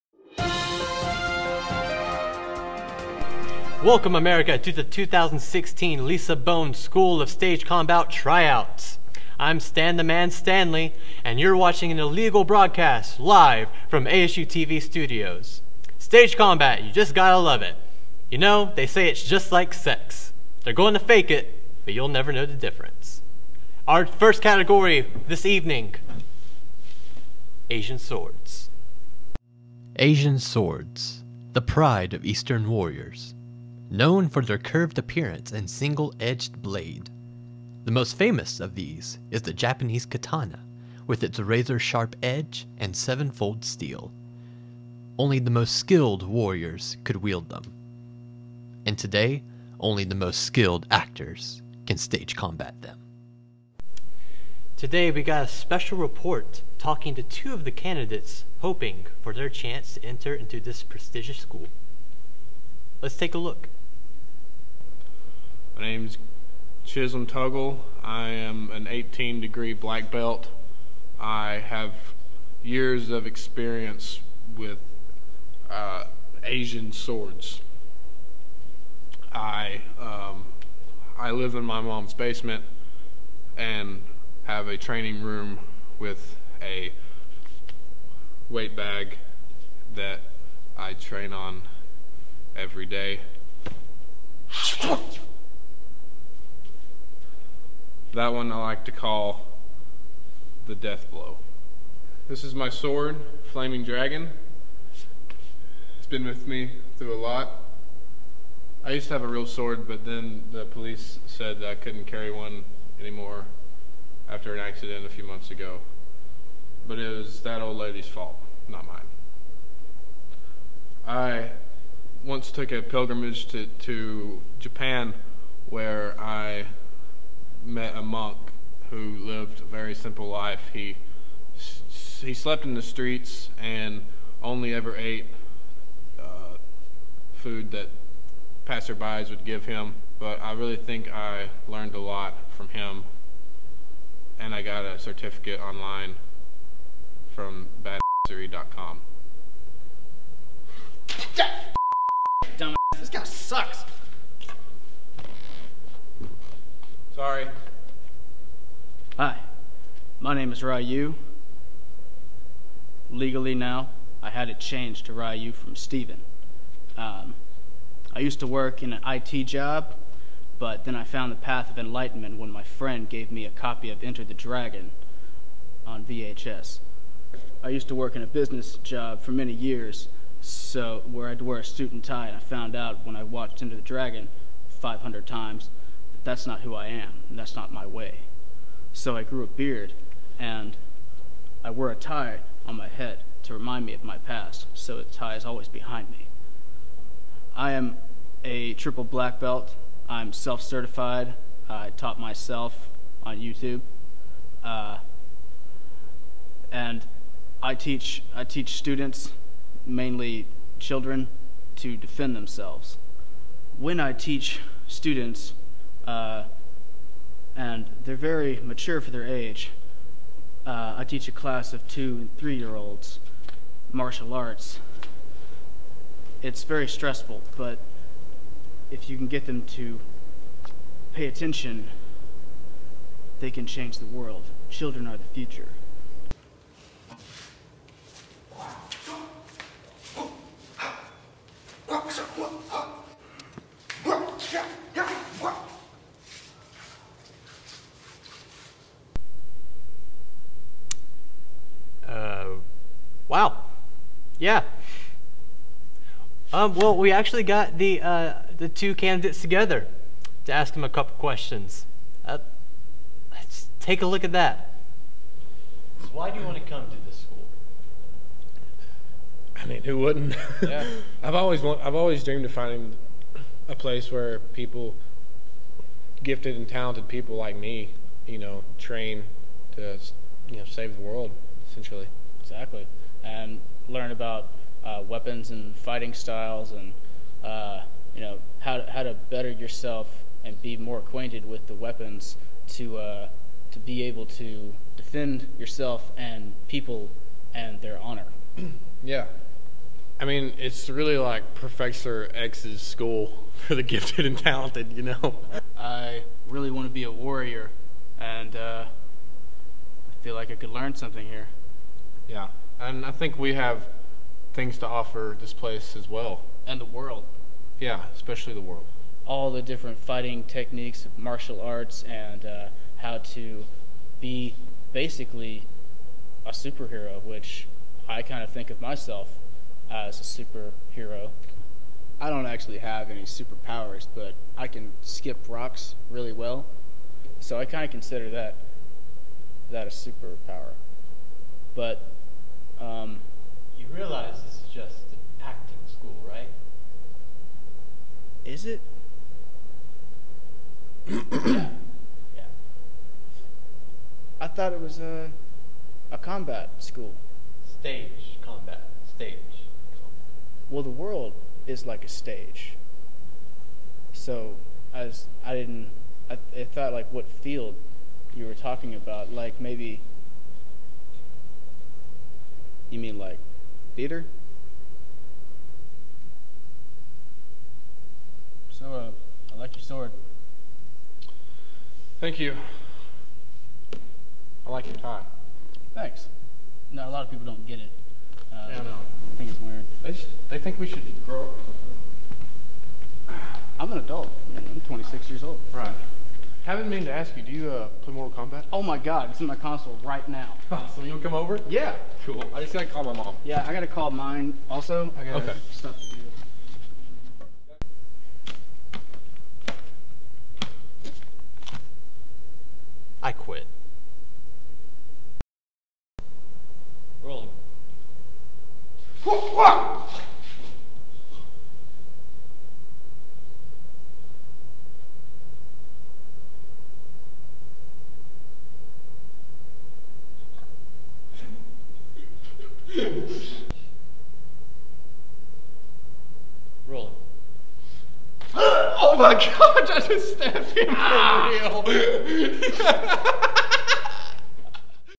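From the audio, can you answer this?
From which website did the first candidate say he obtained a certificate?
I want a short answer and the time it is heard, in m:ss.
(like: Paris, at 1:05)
badassery.com, at 2:27.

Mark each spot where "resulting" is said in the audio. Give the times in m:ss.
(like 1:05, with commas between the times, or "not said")
not said.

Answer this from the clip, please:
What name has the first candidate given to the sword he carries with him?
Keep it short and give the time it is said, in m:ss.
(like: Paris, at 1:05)
Flaming Dragon, at 1:43.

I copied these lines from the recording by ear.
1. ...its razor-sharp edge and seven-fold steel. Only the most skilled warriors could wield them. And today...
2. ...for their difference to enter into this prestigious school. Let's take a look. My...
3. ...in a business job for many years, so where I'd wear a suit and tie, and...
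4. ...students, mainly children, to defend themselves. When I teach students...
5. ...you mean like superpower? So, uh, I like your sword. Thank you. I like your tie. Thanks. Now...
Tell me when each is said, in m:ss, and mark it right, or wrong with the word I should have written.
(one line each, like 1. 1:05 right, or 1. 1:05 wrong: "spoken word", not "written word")
1. 0:41 right
2. 0:59 wrong: "chance", not "difference"
3. 2:58 right
4. 3:28 right
5. 6:12 wrong: "theater", not "superpower".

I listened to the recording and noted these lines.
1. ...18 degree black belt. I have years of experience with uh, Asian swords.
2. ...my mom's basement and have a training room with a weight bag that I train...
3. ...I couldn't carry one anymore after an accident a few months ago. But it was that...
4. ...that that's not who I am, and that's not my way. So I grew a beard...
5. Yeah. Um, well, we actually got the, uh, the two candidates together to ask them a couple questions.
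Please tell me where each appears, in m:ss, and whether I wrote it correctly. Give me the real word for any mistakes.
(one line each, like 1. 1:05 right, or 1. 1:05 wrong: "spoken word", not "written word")
1. 1:08 right
2. 1:21 right
3. 1:51 right
4. 3:06 right
5. 4:14 right.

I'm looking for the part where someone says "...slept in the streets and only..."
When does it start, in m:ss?
2:12.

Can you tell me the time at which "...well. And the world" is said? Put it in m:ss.
5:16.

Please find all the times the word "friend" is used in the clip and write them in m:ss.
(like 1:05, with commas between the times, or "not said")
2:52.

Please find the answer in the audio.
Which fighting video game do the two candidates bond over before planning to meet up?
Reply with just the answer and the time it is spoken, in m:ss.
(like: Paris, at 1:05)
Mortal Kombat, at 6:38.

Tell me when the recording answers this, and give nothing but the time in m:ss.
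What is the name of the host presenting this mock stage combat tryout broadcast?
0:09.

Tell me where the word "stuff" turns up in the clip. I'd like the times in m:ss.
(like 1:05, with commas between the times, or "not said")
6:45.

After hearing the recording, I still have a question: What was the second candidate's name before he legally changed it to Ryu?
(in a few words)
Steven.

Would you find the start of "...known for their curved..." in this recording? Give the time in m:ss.
0:33.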